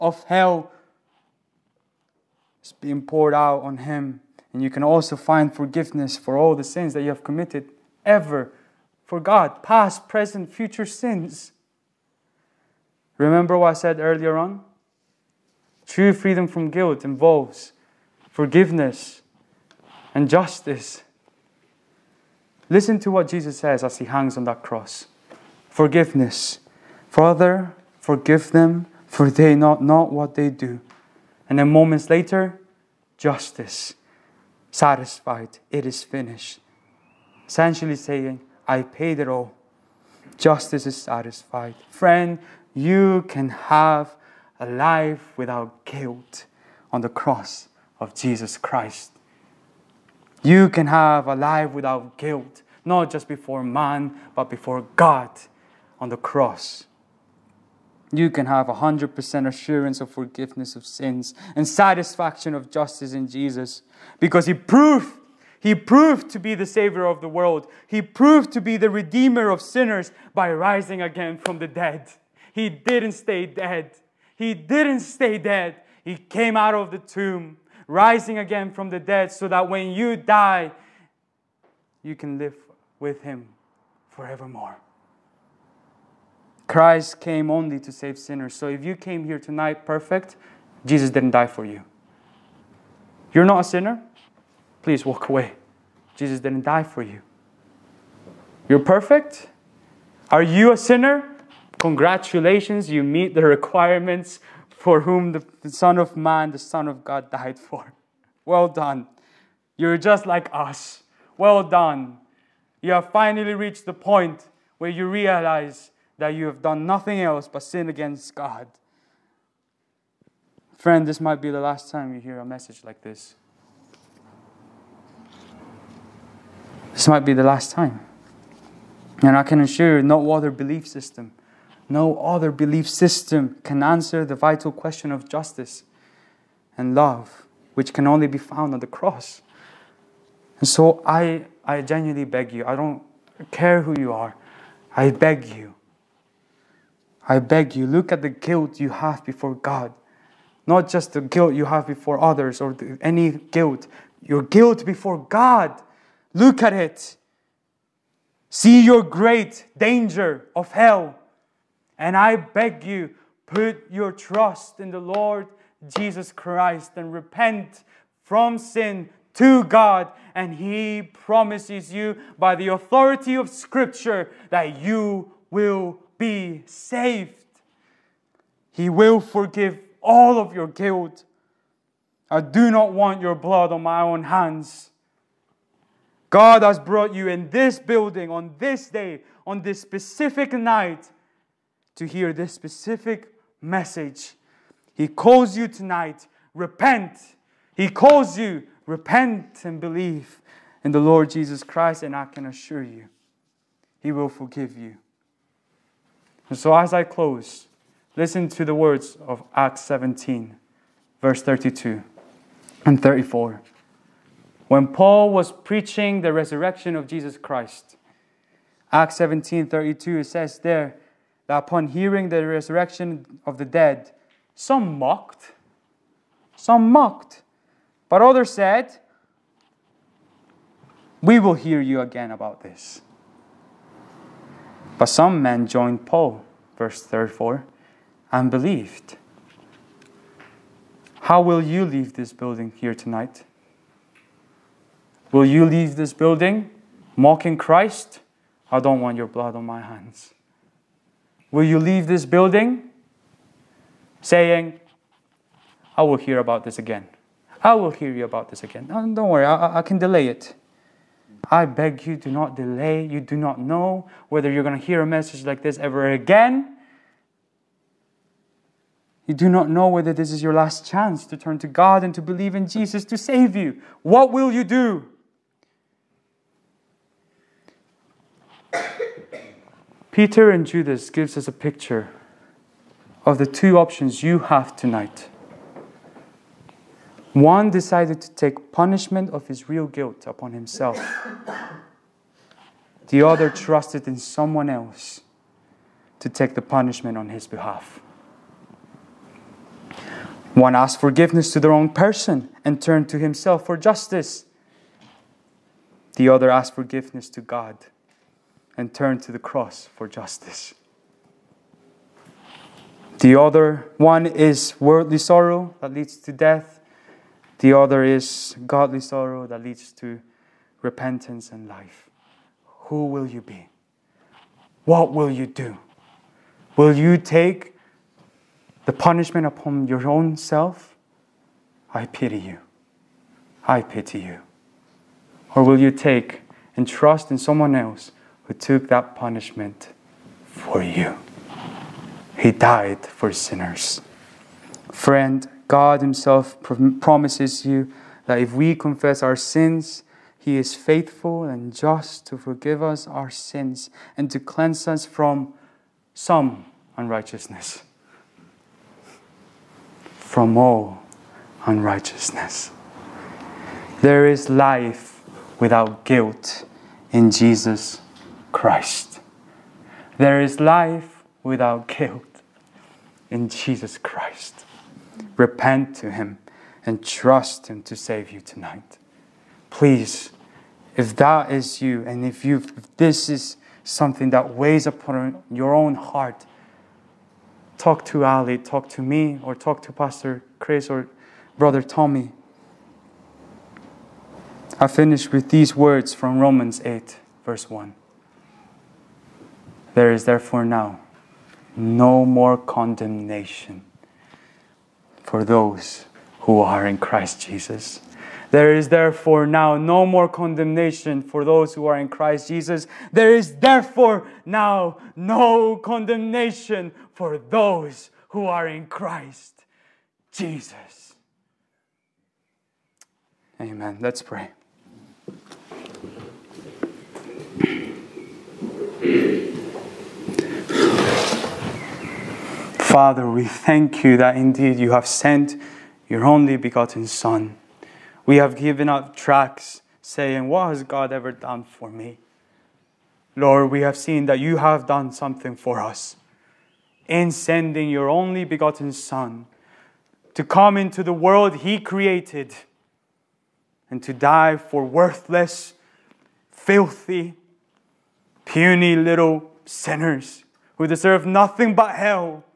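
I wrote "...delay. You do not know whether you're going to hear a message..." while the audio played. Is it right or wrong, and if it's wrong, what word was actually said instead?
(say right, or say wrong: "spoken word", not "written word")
right.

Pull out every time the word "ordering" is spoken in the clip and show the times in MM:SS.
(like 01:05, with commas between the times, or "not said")
not said.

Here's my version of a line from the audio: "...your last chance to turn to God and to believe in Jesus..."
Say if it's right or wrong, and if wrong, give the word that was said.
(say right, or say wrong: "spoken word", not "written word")
right.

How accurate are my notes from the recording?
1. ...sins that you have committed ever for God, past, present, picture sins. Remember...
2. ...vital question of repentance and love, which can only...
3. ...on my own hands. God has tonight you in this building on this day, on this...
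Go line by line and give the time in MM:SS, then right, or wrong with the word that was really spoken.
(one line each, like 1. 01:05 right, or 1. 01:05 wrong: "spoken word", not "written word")
1. 00:06 wrong: "future", not "picture"
2. 02:14 wrong: "justice", not "repentance"
3. 03:03 wrong: "brought", not "tonight".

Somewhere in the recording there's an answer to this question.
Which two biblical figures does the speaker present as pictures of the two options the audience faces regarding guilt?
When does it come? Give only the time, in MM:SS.
04:40.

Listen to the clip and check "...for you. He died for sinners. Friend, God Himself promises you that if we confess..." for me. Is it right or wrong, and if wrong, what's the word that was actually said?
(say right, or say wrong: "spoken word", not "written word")
right.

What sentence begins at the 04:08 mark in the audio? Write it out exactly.
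I don't want your blood on my hands will you leave this building saying, I will hear about this again.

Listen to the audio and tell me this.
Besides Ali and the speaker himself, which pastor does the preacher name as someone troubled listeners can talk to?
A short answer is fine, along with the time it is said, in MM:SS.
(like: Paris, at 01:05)
Pastor Chris, at 06:29.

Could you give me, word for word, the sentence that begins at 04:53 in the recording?
The other trusted in someone else to take the punishment on his behalf.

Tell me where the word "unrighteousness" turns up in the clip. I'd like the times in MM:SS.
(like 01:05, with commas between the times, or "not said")
05:56, 06:01.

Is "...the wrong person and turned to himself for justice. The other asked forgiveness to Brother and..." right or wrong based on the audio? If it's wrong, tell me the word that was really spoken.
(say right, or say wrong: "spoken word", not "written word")
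wrong: "God", not "Brother".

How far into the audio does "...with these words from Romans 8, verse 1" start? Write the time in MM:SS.
06:35.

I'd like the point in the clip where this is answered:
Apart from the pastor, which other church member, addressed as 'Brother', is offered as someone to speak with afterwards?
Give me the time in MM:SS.
06:31.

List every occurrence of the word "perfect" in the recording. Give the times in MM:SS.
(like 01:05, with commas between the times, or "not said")
01:29, 01:38.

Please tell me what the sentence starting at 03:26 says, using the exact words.
And so, as I close, listen to the words of Acts 17, verse 32 and 34.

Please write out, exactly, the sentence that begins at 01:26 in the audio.
Christ came only to save sinners.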